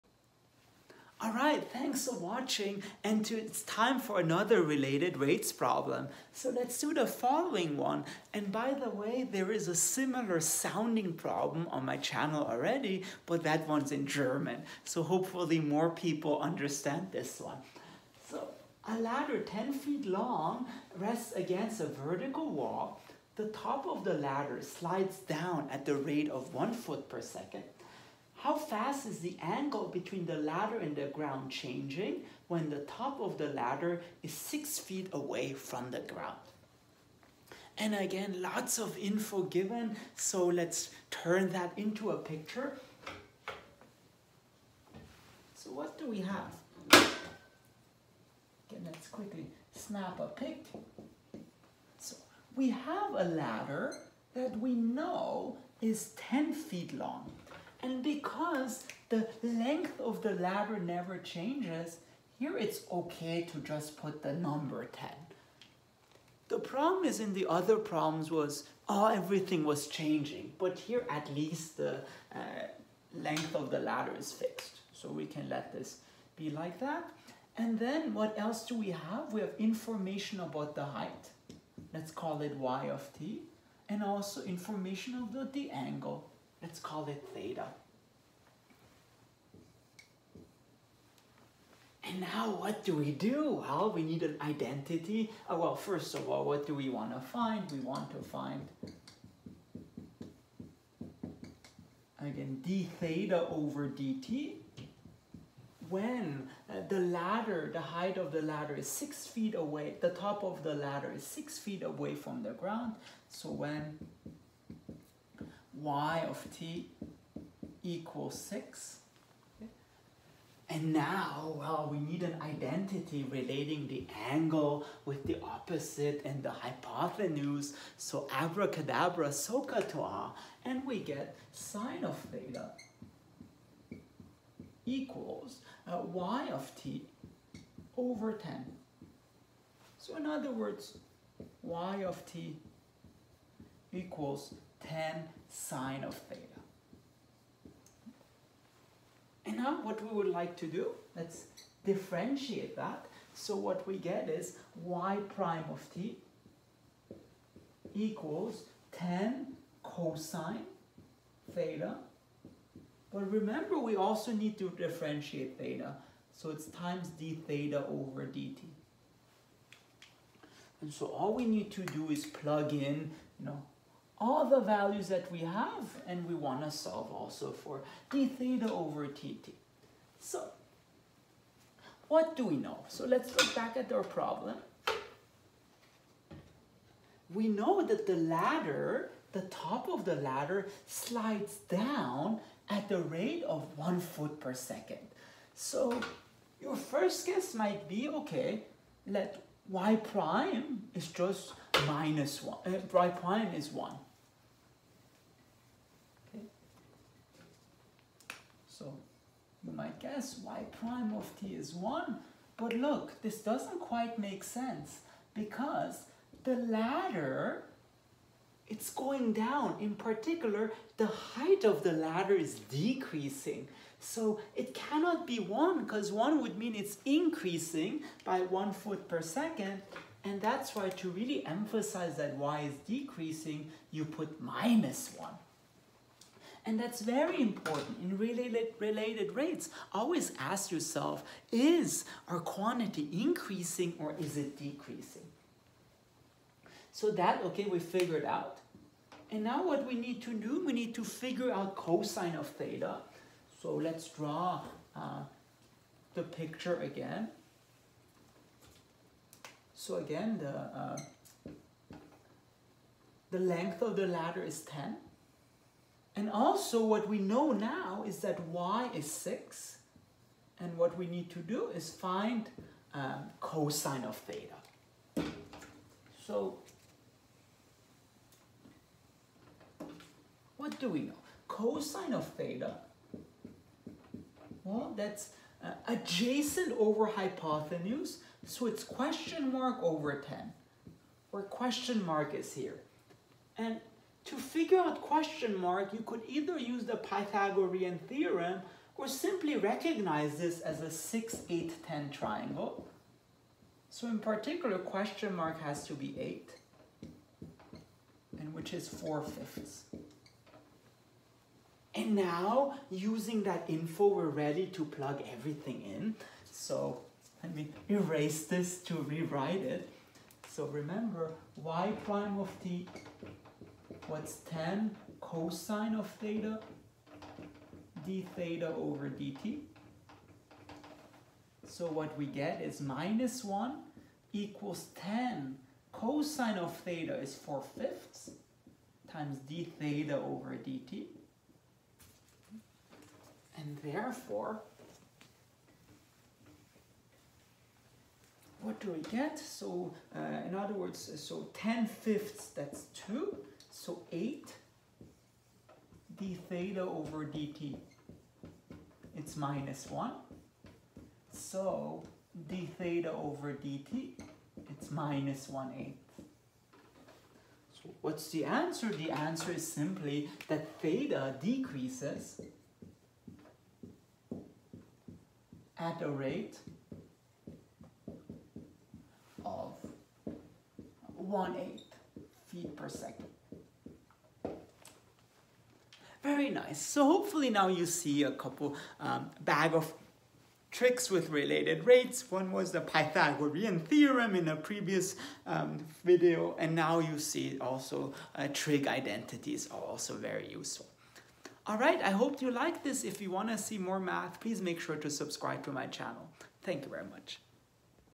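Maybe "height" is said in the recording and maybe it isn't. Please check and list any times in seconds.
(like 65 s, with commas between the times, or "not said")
80 s, 107 s, 221 s.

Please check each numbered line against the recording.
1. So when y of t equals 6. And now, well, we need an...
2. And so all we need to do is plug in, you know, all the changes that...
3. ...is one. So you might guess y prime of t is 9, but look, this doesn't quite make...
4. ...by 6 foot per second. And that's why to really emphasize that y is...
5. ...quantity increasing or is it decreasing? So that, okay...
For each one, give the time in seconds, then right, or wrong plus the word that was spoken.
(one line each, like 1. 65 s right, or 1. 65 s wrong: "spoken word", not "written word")
1. 113 s right
2. 170 s wrong: "values", not "changes"
3. 203 s wrong: "1", not "9"
4. 228 s wrong: "1", not "6"
5. 242 s right.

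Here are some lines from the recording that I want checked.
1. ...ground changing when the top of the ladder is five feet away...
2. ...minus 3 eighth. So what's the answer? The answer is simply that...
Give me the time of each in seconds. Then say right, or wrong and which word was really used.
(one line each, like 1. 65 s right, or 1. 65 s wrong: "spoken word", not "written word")
1. 31 s wrong: "six", not "five"
2. 364 s wrong: "1", not "3".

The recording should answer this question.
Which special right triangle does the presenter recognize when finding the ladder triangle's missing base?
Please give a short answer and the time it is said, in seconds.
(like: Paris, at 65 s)
6, 8, 10 triangle, at 300 s.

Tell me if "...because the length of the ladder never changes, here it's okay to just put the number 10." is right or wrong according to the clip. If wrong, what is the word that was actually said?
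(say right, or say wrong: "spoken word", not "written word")
right.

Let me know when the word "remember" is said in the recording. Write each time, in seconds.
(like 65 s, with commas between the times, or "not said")
163 s, 320 s.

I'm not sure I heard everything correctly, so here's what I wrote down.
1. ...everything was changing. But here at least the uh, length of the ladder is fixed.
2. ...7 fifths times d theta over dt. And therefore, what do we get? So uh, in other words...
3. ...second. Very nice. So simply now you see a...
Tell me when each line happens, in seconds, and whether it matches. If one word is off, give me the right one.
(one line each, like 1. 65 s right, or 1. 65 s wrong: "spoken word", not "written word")
1. 69 s right
2. 337 s wrong: "4", not "7"
3. 382 s wrong: "hopefully", not "simply".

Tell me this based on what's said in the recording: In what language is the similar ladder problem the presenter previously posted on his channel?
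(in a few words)
German.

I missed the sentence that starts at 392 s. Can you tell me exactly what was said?
One was the Pythagorean theorem in a previous um, video, and now you see also uh, trig identities are also very useful.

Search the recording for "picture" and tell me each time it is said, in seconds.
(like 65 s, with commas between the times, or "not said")
42 s, 256 s.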